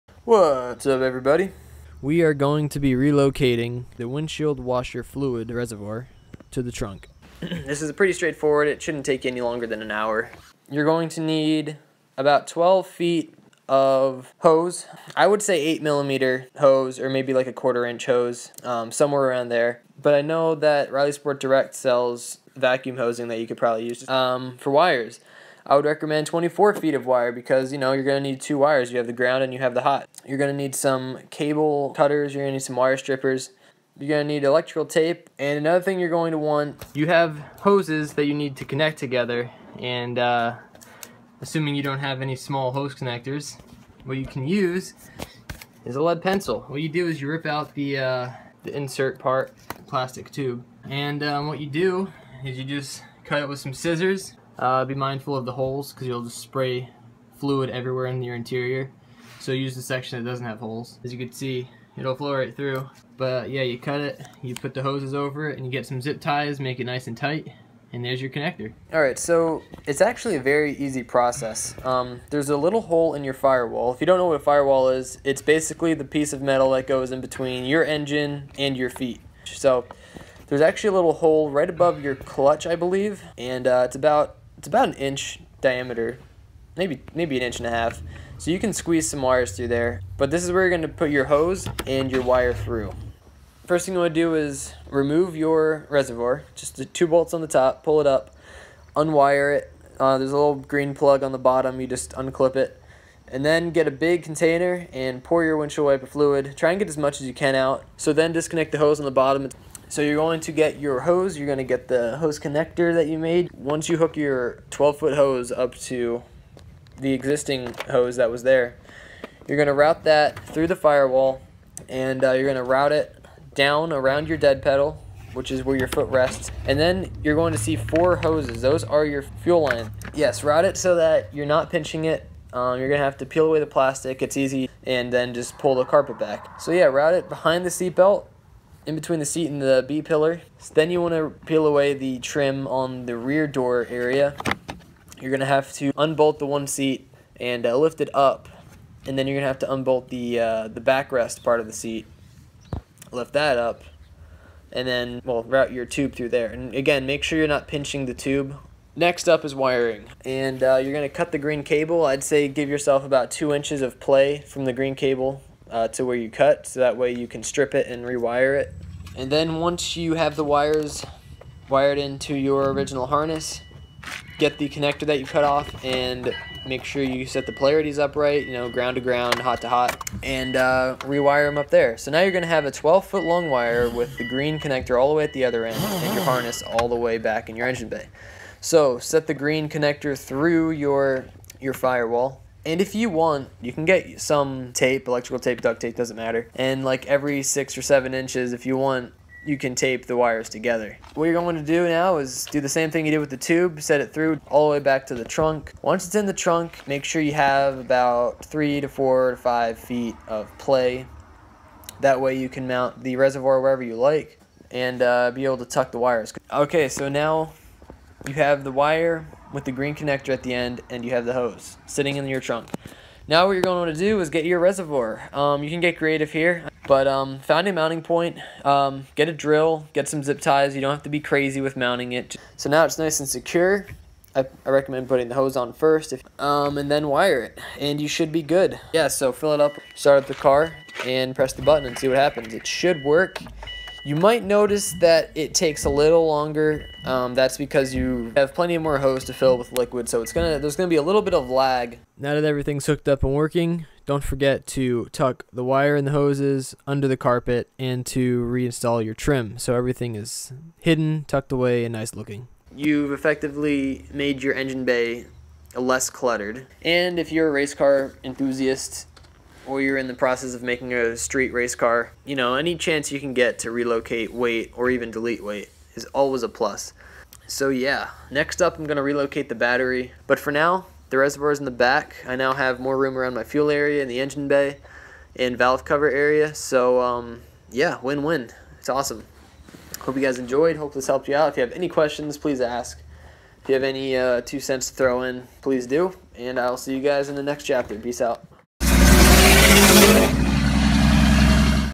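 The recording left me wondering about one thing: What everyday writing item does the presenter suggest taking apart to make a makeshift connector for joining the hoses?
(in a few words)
Lead pencil.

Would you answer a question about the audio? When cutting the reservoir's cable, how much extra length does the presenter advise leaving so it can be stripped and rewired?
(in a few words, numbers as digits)
2 inches.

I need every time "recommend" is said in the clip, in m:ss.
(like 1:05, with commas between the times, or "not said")
0:25, 3:54.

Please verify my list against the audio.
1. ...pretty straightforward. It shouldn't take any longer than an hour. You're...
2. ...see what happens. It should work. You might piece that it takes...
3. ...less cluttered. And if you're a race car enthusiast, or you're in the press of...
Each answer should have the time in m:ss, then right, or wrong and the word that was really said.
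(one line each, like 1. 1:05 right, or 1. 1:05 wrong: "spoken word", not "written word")
1. 0:07 right
2. 4:01 wrong: "notice", not "piece"
3. 4:25 wrong: "process", not "press".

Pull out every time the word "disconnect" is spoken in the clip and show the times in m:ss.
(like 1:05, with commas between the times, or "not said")
1:48.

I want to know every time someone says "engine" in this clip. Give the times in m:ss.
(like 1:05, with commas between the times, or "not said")
1:17, 3:07, 4:24, 4:44.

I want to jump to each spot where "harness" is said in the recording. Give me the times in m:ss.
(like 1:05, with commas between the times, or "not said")
2:53, 3:06.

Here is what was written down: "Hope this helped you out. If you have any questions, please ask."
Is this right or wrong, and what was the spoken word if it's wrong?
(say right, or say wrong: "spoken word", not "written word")
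right.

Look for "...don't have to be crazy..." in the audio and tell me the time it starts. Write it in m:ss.
3:50.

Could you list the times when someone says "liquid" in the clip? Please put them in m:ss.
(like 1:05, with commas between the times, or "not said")
4:09.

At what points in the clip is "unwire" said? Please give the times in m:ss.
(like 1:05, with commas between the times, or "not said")
1:38.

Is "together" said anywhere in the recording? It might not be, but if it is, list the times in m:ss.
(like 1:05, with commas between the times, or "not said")
0:38, 3:20.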